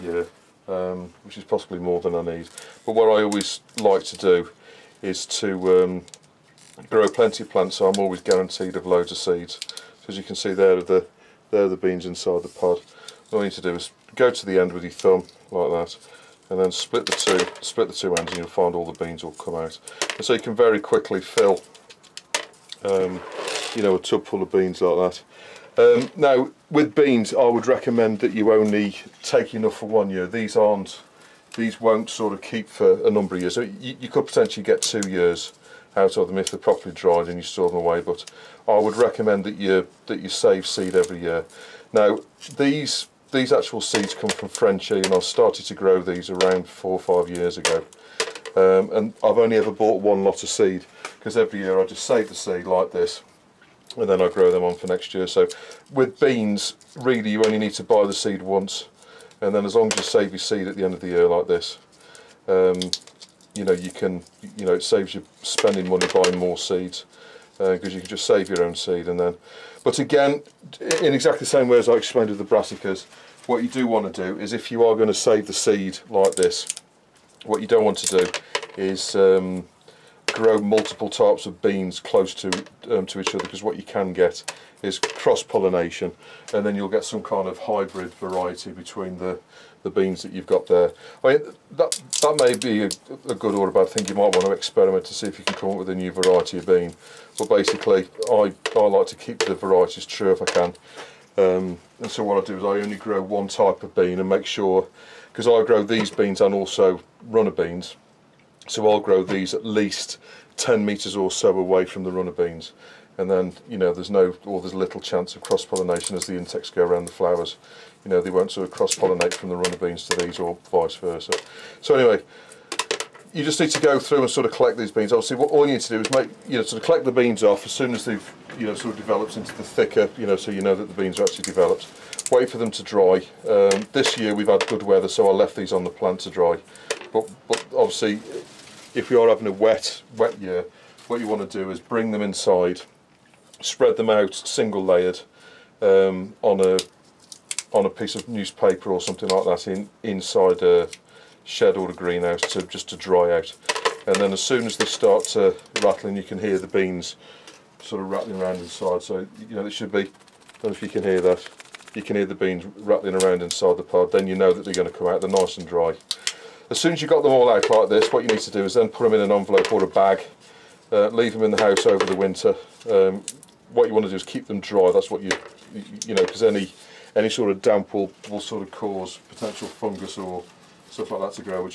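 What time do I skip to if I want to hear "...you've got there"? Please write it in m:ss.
1:30.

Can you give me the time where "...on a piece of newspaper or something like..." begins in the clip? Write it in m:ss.
2:27.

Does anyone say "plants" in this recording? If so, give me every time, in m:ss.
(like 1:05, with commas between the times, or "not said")
0:07, 2:15.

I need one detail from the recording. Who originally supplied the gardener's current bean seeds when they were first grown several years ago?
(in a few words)
Frenchy.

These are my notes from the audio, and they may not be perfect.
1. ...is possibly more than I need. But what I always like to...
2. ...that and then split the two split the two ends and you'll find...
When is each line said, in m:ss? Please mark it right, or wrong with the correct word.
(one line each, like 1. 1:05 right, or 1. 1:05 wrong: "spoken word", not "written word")
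1. 0:01 right
2. 0:15 right.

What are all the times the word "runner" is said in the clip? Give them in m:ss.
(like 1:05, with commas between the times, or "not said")
1:47, 1:52, 1:59.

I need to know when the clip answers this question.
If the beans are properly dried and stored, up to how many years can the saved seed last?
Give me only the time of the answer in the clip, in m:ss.
0:34.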